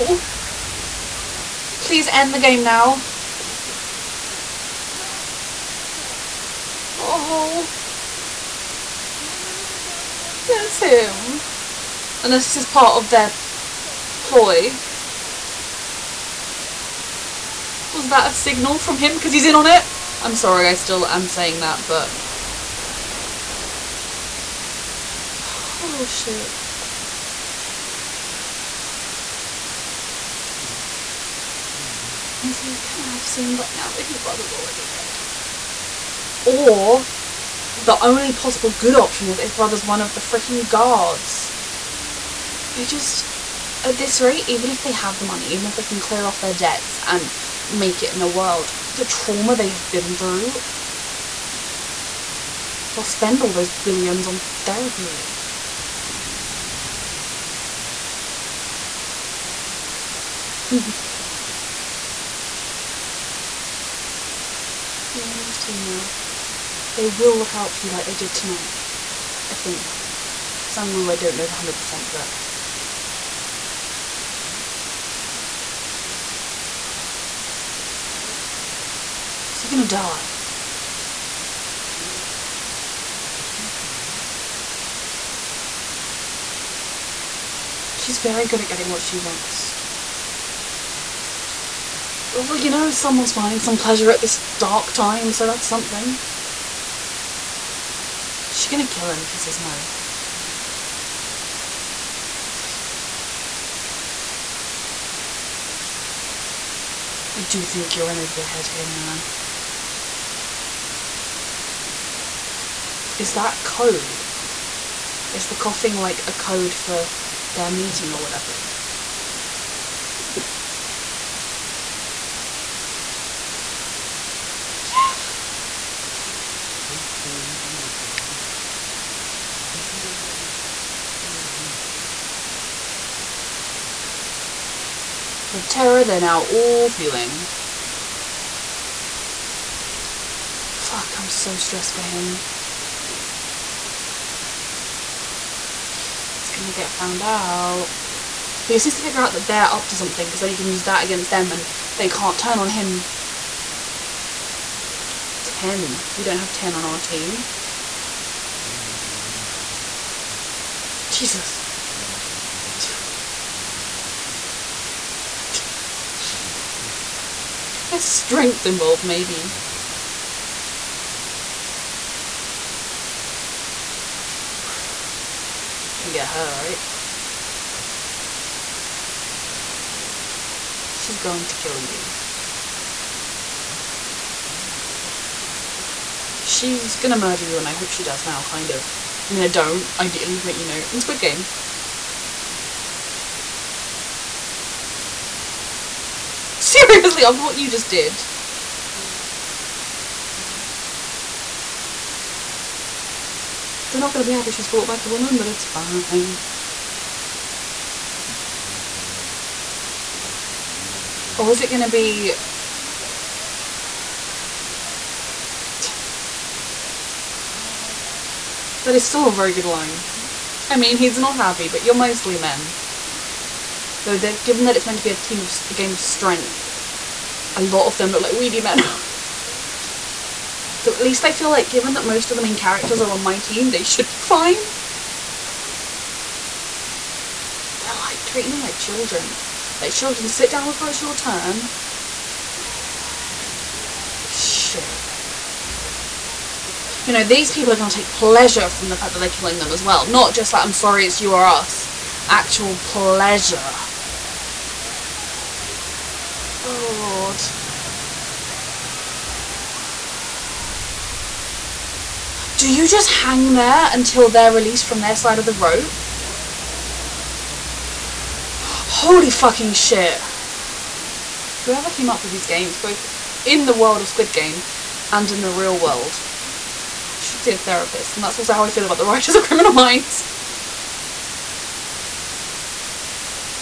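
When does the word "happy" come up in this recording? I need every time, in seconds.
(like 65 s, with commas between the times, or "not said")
204 s, 221 s.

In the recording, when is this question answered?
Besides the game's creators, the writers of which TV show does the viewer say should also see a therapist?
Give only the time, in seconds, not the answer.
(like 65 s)
279 s.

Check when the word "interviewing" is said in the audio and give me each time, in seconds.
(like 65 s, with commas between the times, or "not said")
not said.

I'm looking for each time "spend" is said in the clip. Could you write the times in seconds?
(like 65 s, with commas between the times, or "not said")
53 s.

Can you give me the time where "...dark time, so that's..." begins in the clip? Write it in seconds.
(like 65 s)
94 s.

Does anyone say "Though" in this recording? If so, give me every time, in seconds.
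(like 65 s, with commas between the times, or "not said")
224 s.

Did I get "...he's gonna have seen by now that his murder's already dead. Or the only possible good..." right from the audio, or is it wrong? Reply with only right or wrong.
wrong.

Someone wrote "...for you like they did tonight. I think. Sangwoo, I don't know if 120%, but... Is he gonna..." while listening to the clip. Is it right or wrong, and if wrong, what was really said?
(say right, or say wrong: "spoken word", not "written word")
wrong: "100", not "120".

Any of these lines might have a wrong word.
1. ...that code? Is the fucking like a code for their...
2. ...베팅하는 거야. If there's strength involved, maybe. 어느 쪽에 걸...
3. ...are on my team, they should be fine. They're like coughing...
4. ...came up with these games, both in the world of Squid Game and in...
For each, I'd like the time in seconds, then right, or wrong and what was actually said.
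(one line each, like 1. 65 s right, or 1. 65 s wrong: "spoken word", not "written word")
1. 113 s wrong: "coughing", not "fucking"
2. 166 s right
3. 233 s wrong: "treating", not "coughing"
4. 271 s right.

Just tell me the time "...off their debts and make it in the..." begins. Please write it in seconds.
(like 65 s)
46 s.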